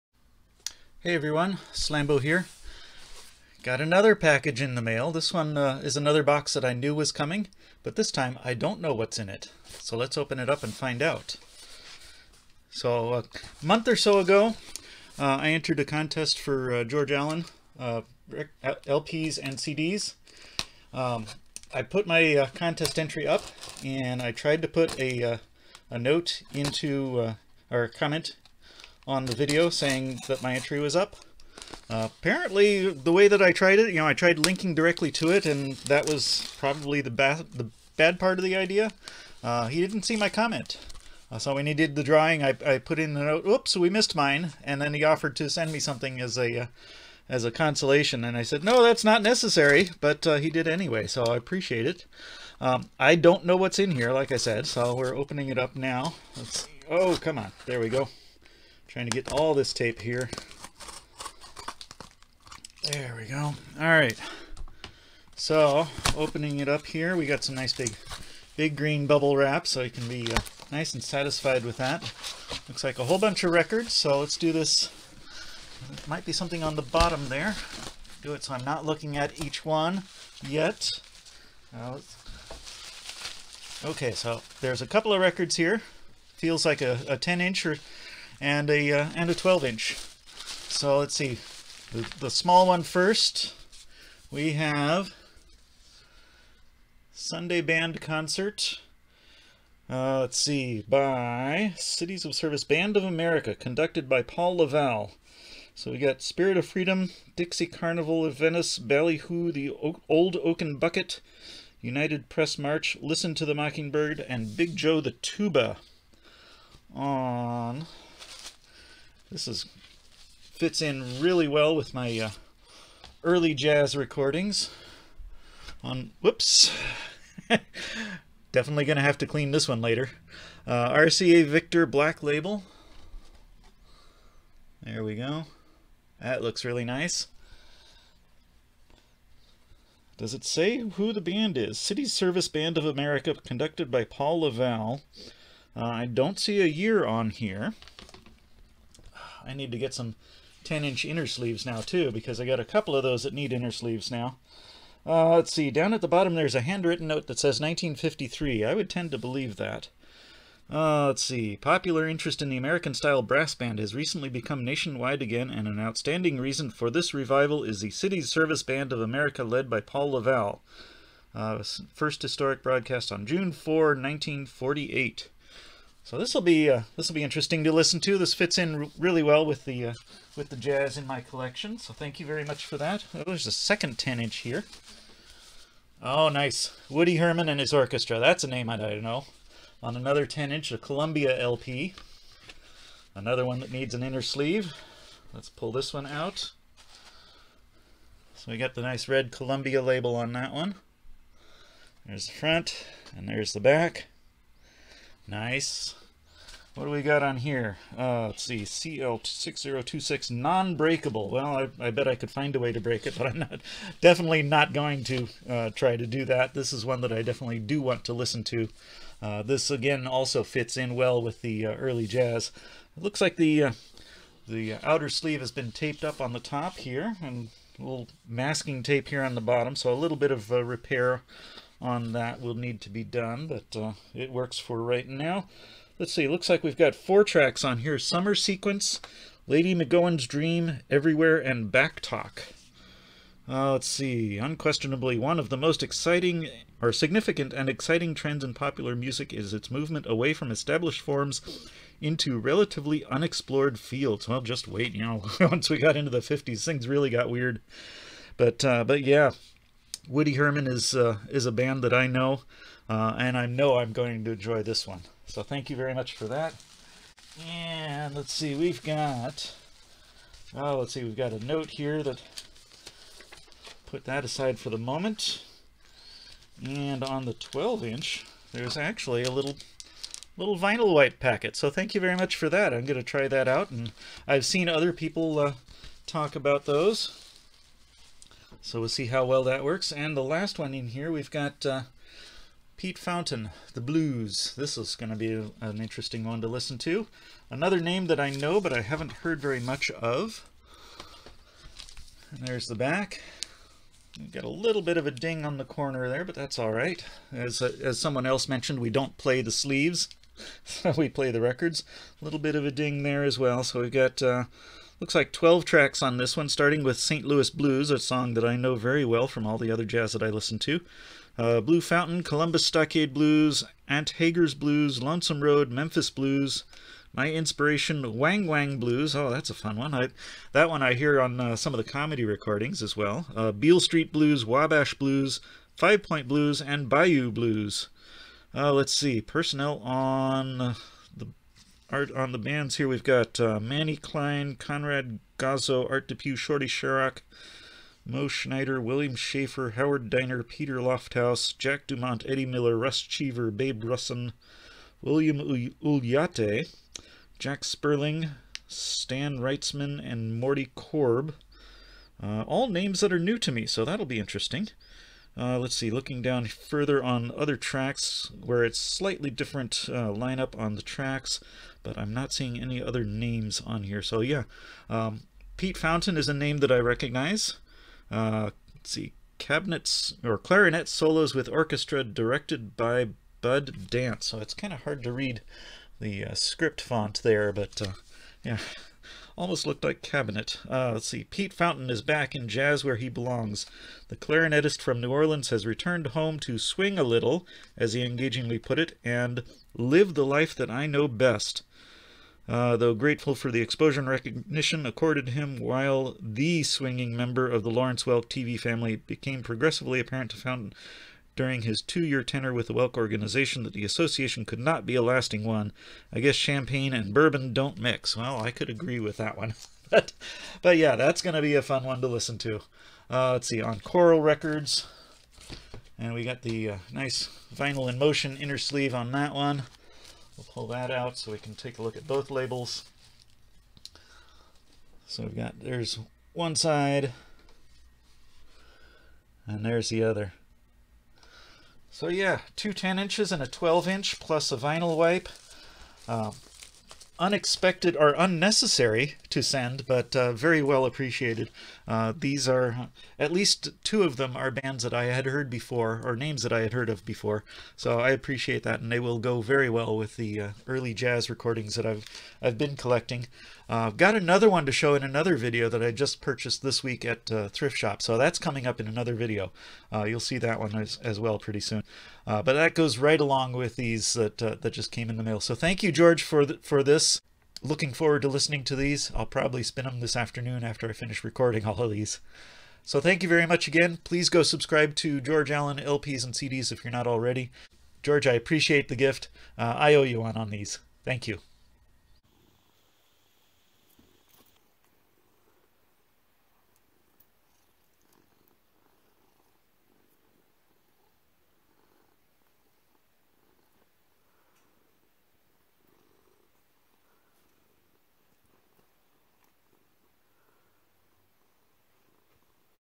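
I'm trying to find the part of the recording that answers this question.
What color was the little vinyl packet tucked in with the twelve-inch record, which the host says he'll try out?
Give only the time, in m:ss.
4:40.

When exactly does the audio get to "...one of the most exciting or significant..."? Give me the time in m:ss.
4:05.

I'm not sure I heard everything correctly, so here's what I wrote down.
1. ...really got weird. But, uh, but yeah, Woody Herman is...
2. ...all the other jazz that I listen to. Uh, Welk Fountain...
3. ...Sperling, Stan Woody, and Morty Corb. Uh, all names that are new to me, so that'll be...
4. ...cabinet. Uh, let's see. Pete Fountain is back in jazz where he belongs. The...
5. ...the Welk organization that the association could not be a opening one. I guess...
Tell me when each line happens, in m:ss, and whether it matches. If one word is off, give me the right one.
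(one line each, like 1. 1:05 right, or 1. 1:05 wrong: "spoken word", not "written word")
1. 4:16 right
2. 5:19 wrong: "Blue", not "Welk"
3. 5:57 wrong: "Wrightsman", not "Woody"
4. 6:30 right
5. 6:52 wrong: "lasting", not "opening".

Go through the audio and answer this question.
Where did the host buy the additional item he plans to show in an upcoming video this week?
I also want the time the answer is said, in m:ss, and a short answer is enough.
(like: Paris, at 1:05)
Thrift Shop, at 7:47.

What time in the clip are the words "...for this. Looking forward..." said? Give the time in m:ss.
7:56.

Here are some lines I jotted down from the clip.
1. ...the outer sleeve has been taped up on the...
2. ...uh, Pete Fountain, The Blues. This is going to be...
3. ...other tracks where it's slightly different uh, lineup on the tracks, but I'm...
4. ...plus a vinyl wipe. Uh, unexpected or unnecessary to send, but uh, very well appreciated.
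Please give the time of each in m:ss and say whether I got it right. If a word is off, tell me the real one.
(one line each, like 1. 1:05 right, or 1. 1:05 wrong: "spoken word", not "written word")
1. 3:44 right
2. 4:51 right
3. 6:07 right
4. 7:24 right.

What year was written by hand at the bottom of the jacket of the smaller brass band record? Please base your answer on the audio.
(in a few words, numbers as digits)
1953.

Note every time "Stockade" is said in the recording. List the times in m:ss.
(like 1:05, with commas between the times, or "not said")
5:22.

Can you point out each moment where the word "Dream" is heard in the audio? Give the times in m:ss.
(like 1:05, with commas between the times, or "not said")
4:00.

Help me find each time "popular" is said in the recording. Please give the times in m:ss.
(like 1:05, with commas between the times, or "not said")
2:41, 4:08.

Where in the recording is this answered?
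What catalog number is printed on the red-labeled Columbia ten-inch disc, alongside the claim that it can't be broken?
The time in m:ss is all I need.
3:28.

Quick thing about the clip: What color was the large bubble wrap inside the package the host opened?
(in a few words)
green.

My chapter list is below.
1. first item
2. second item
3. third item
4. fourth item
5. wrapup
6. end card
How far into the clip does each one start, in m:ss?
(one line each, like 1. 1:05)
1. 1:32
2. 3:02
3. 4:37
4. 4:49
5. 7:22
6. 8:12.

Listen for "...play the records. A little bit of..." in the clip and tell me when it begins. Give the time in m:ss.
5:11.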